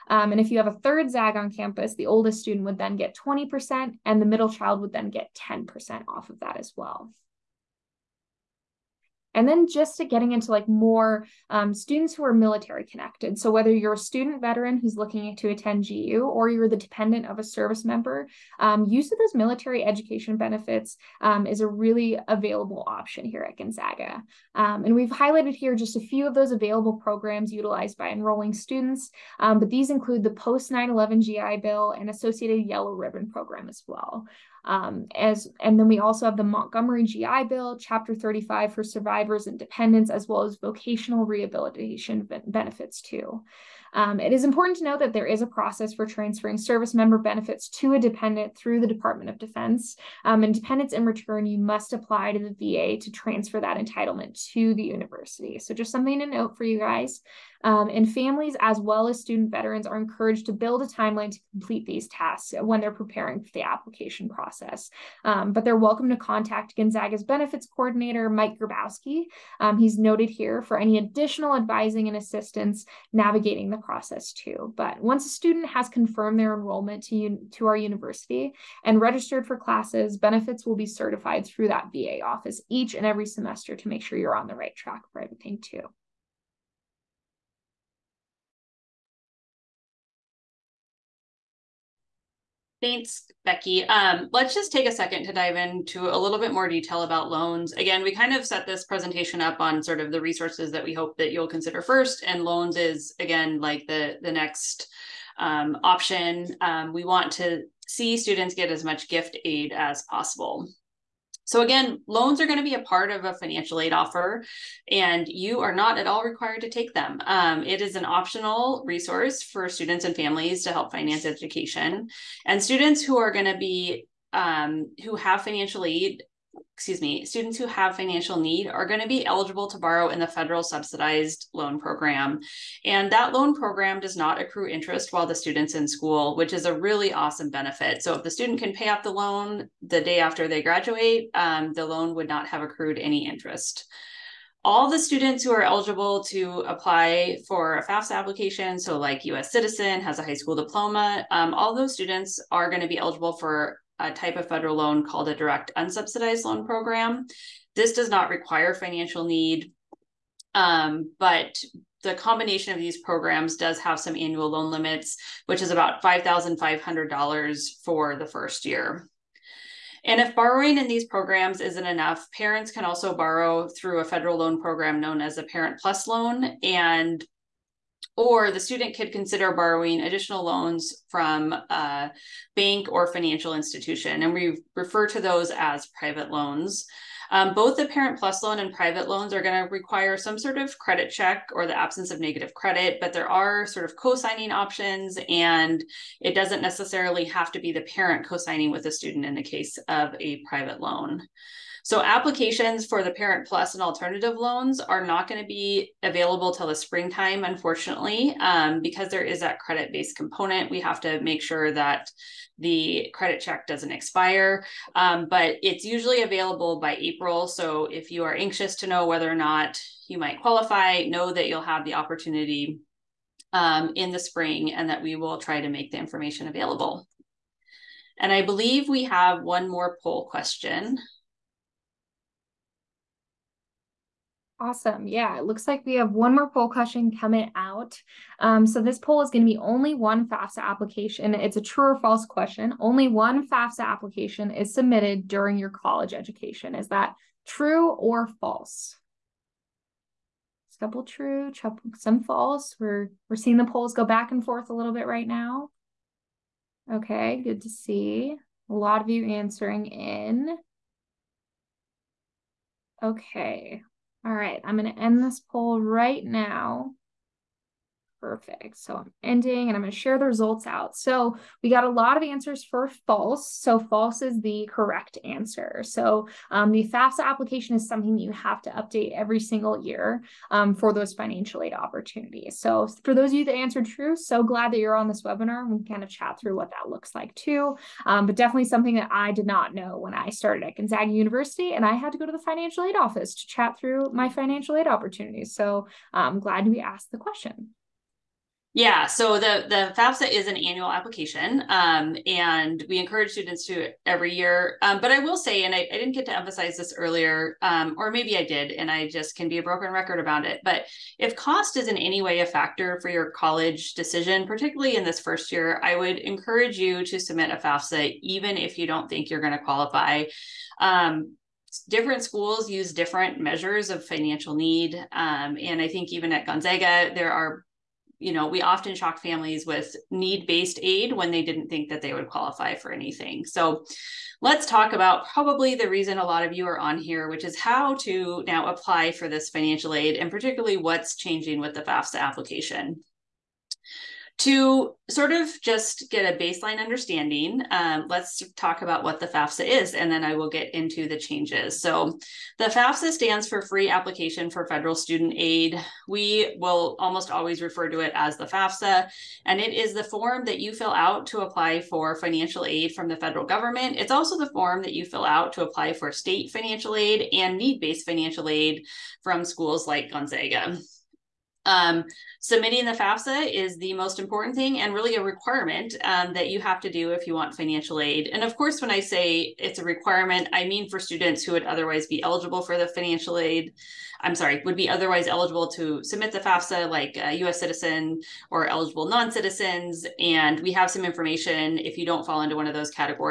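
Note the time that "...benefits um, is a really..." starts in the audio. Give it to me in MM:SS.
00:20.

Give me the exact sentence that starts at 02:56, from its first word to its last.
And or the student could consider borrowing additional loans from a bank or financial institution.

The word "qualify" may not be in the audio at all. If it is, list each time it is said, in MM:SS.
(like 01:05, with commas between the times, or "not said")
03:40, 05:19, 05:32.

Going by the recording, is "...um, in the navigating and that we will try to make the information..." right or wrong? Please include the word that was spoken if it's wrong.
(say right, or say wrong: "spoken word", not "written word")
wrong: "spring", not "navigating".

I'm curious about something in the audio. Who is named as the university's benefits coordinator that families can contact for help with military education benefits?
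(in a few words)
Mike Grabowski.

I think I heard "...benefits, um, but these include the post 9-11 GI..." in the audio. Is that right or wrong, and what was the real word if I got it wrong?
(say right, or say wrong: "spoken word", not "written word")
wrong: "students", not "benefits".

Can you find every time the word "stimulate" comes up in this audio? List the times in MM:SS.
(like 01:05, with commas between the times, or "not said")
not said.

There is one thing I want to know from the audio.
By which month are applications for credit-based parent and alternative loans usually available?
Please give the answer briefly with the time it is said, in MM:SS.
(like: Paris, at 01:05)
April, at 03:36.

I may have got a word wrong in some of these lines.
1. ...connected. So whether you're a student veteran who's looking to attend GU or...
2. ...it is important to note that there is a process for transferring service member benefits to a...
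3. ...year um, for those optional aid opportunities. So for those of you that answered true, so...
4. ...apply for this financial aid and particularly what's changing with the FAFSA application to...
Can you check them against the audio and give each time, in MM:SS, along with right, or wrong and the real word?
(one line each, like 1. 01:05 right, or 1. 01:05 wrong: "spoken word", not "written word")
1. 00:12 right
2. 00:44 right
3. 04:39 wrong: "financial", not "optional"
4. 05:38 right.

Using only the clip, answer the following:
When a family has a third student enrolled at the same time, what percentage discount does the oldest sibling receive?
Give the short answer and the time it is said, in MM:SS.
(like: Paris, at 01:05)
20%, at 00:03.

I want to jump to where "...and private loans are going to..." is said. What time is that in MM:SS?
03:08.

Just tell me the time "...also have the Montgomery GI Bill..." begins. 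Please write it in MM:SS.
00:35.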